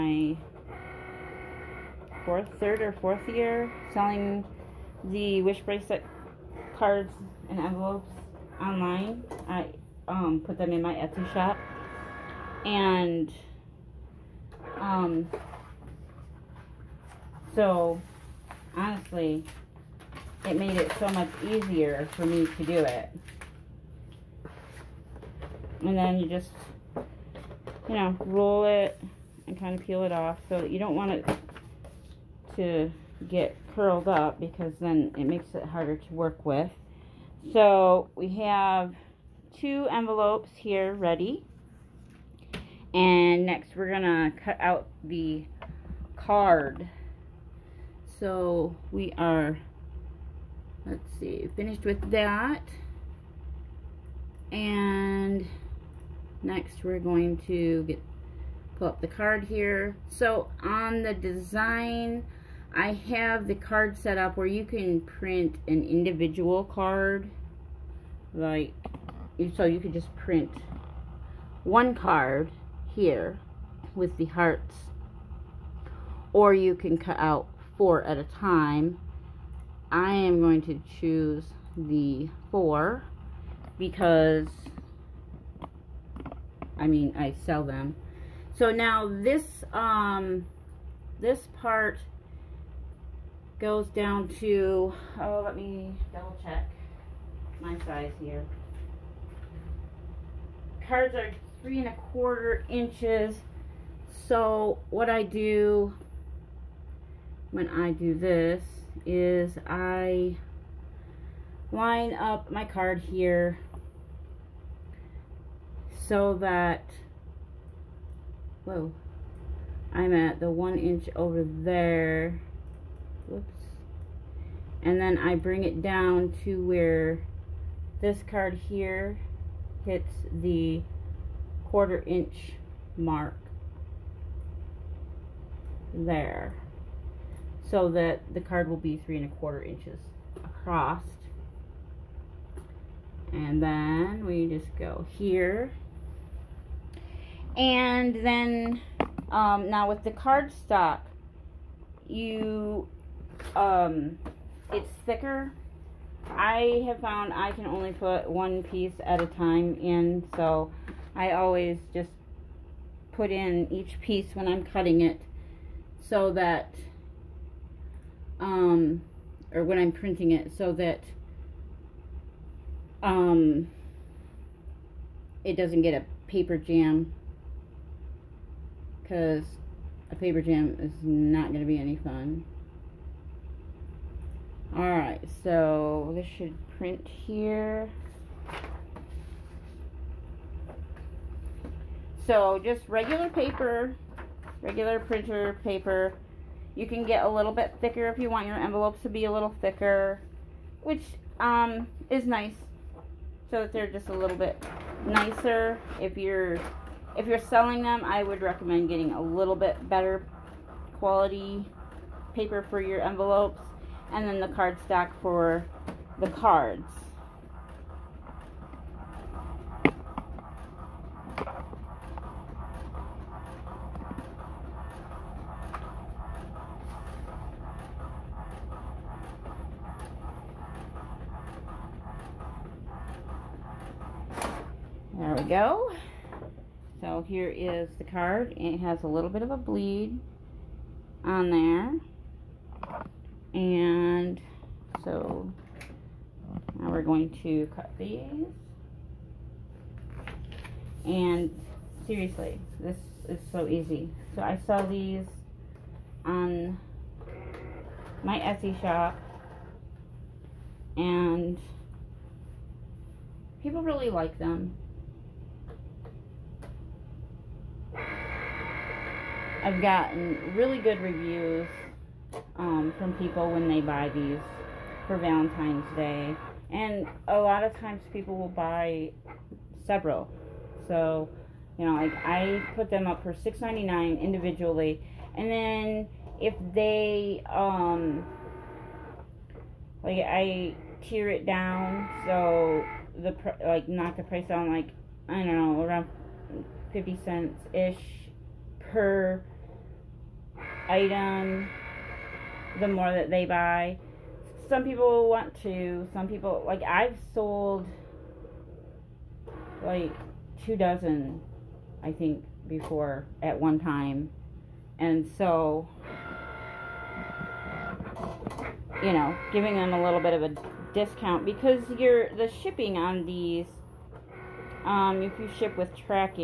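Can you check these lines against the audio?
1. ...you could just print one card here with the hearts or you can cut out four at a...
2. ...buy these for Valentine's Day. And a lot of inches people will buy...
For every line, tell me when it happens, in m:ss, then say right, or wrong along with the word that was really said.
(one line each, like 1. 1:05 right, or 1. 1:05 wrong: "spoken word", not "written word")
1. 1:09 right
2. 4:33 wrong: "times", not "inches".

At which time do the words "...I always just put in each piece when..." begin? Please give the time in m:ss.
2:41.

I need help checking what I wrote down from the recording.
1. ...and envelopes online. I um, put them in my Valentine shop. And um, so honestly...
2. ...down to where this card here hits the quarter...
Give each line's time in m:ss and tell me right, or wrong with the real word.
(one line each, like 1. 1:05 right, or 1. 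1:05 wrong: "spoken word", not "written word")
1. 0:07 wrong: "Etsy", not "Valentine"
2. 2:05 right.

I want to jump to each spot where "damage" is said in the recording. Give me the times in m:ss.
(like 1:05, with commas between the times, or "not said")
not said.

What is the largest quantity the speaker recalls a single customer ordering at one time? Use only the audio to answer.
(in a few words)
2 dozen.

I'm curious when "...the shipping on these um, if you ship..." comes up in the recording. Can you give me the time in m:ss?
5:22.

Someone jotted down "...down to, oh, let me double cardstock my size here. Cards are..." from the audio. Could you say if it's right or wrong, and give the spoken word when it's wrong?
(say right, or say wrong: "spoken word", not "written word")
wrong: "check", not "cardstock".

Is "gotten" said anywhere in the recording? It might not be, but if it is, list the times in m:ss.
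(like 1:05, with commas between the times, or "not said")
4:29.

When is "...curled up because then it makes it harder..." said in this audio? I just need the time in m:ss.
0:33.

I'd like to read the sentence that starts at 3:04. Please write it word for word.
Alright, so this should print here.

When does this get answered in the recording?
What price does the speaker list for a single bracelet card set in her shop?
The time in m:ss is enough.
4:43.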